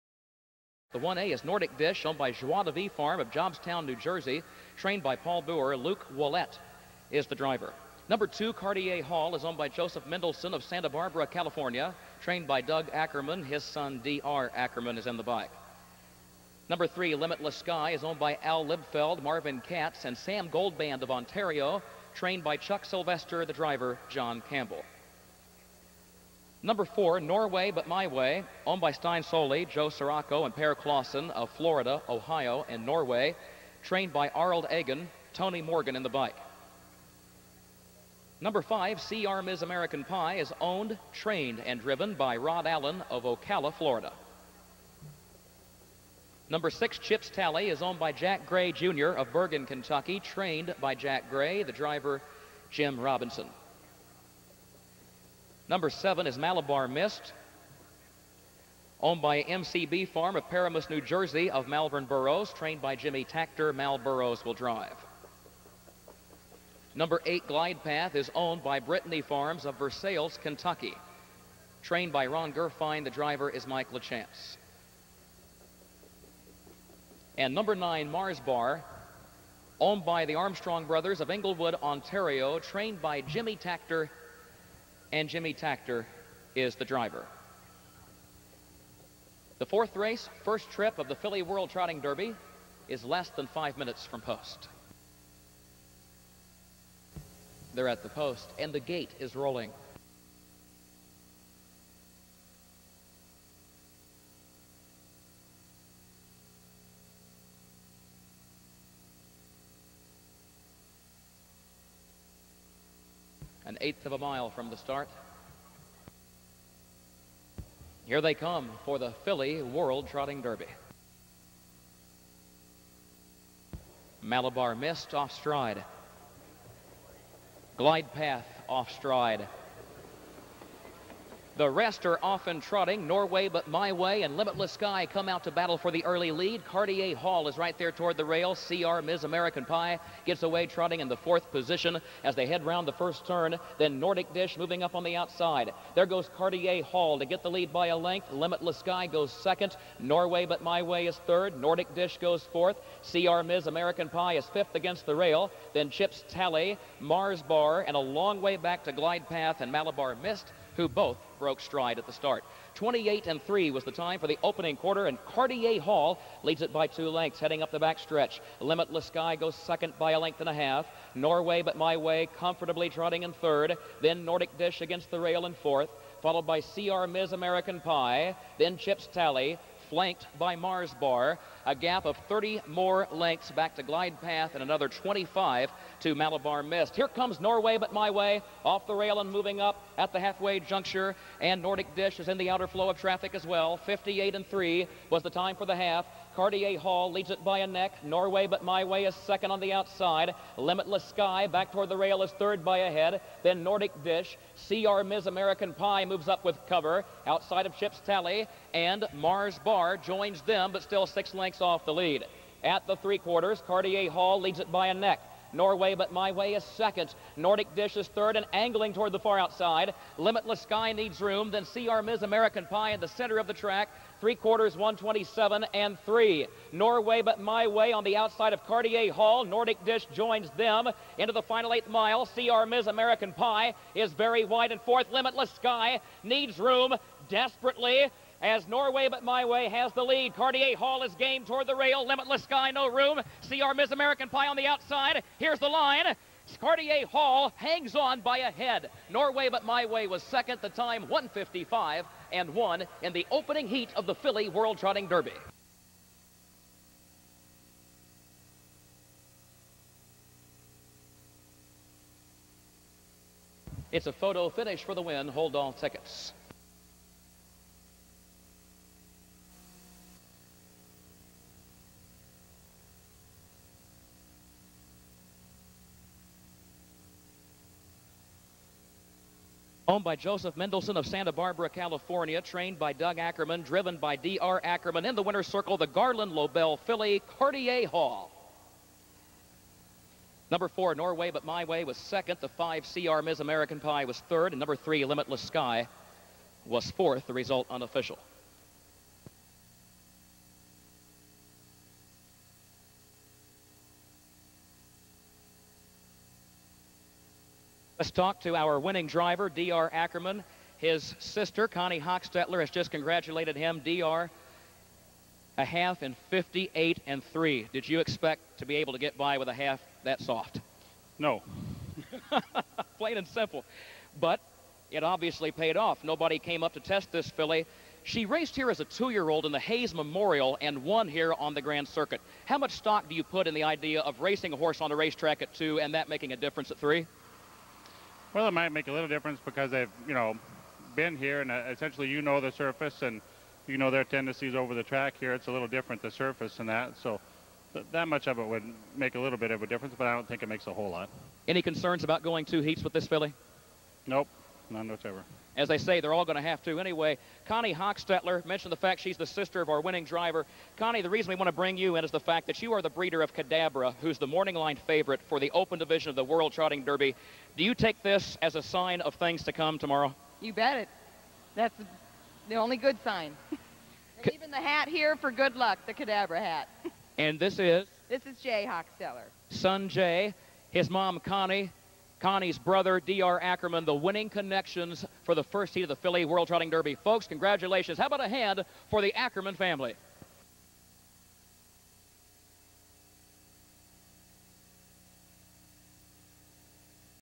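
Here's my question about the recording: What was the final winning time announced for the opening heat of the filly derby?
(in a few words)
155 and 1.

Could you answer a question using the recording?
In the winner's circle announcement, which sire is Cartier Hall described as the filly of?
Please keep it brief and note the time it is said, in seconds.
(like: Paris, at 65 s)
Garland Lobell, at 285 s.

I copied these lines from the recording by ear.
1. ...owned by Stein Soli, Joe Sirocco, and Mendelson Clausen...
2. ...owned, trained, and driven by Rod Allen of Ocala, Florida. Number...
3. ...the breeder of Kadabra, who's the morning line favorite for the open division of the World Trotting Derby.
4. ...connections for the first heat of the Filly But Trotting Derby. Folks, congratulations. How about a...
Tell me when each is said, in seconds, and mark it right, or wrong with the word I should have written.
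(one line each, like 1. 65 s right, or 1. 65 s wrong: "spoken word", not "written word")
1. 28 s wrong: "Per", not "Mendelson"
2. 40 s right
3. 362 s right
4. 384 s wrong: "World", not "But".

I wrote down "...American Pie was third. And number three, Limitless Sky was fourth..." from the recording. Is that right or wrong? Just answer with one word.
right.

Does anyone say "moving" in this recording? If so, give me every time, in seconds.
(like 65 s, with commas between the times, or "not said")
144 s, 189 s.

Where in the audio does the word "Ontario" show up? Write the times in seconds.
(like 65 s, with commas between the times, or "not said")
21 s, 81 s.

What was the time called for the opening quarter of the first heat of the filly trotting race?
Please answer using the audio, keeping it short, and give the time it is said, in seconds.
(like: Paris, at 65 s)
28 and 3, at 162 s.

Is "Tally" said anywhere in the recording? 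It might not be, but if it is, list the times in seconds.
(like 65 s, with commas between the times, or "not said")
47 s, 156 s, 179 s, 208 s.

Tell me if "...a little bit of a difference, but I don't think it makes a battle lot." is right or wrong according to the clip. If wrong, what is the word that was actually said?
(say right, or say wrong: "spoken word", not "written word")
wrong: "whole", not "battle".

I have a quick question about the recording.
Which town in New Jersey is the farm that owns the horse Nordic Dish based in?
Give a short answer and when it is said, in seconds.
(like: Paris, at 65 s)
Jobstown, at 3 s.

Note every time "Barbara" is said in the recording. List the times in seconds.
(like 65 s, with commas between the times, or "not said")
10 s, 281 s.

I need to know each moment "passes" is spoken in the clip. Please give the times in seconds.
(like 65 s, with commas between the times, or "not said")
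not said.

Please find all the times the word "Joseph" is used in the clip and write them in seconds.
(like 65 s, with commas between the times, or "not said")
9 s, 280 s.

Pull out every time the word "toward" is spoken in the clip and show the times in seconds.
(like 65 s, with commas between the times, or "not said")
137 s, 201 s, 218 s, 241 s.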